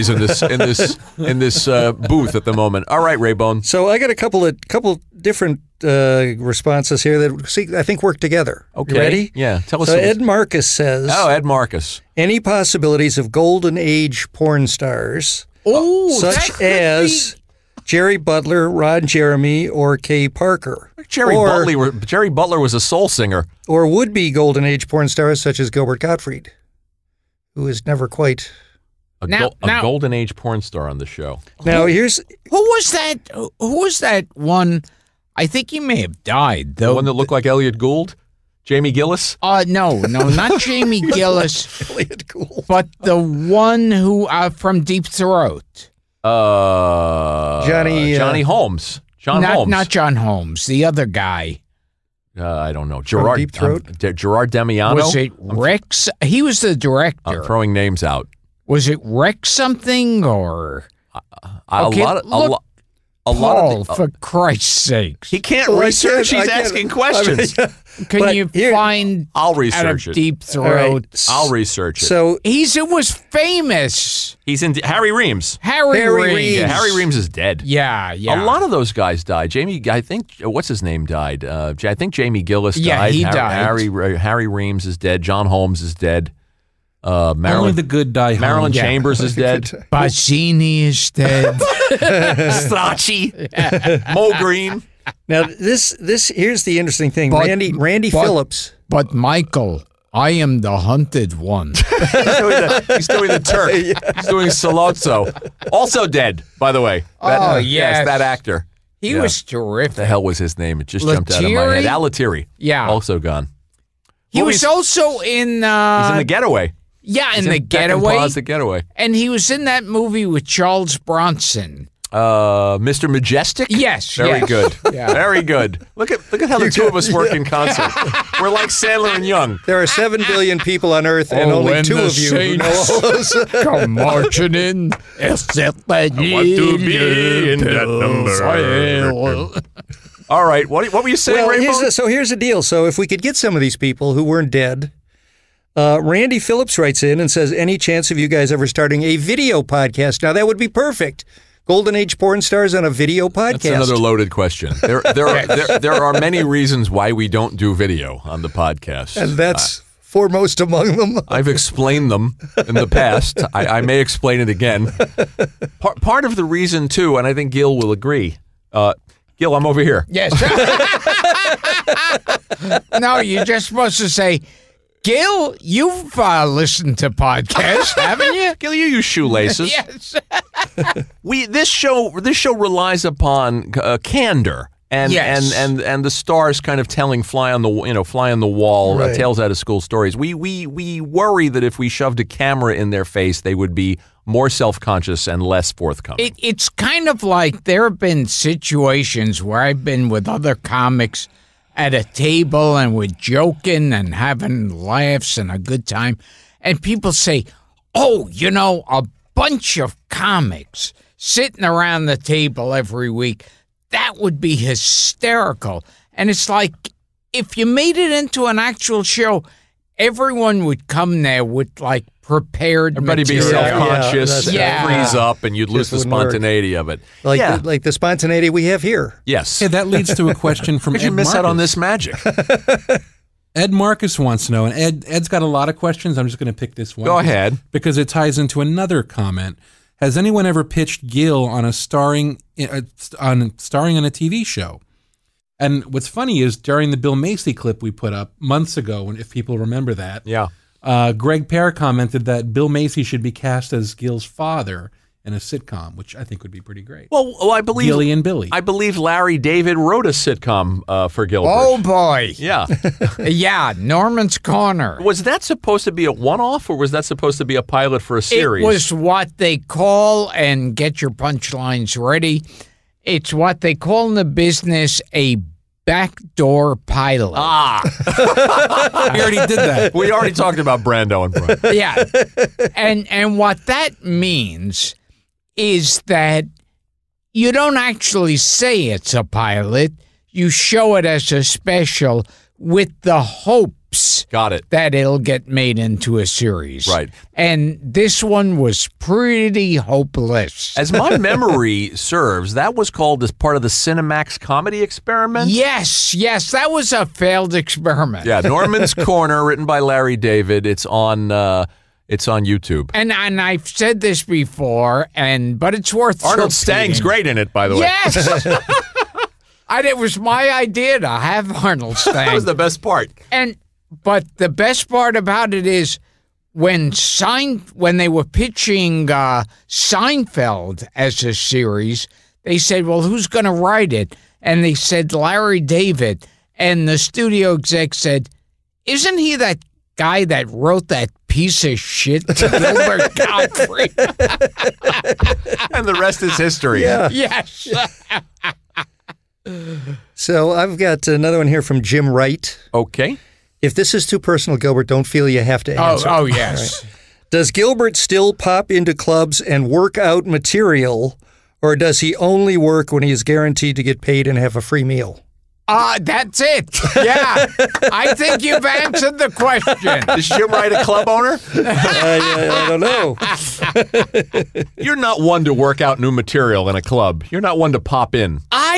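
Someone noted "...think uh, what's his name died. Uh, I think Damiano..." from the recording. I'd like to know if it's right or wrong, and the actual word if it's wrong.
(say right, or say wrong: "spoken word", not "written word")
wrong: "Jamie", not "Damiano".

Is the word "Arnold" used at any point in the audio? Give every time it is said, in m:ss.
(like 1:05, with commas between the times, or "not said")
5:16, 5:21.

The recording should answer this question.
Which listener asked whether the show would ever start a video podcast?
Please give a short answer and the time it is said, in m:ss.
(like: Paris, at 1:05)
Randy Phillips, at 2:26.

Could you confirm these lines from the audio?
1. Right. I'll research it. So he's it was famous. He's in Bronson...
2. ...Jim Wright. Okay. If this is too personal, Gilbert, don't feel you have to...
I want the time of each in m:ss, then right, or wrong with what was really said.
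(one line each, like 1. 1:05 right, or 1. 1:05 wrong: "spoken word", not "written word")
1. 1:11 wrong: "Harry", not "Bronson"
2. 5:51 right.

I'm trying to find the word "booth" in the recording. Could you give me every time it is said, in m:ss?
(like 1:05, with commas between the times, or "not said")
0:01.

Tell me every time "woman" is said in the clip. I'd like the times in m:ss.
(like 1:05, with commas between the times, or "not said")
not said.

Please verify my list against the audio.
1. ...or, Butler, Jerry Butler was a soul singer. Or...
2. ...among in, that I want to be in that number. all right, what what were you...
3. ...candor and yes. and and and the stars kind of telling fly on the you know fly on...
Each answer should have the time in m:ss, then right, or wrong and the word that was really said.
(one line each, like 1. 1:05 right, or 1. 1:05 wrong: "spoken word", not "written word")
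1. 0:21 right
2. 2:13 wrong: "marching", not "among"
3. 3:04 right.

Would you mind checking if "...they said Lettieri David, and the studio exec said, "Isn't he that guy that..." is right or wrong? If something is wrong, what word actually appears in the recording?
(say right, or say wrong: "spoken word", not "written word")
wrong: "Larry", not "Lettieri".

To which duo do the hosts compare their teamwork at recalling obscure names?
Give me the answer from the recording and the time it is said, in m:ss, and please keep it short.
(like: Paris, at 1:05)
Sandler and Young, at 2:08.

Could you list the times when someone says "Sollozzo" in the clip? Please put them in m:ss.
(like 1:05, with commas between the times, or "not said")
1:44.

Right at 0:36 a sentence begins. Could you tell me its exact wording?
The one that looked like Elliot Gould, Jamie Gillis.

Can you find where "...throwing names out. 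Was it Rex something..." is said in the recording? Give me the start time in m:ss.
0:57.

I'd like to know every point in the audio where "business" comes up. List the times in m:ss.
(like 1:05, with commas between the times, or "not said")
4:34.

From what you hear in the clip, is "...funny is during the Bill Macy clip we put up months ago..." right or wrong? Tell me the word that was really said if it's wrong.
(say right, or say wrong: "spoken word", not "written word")
right.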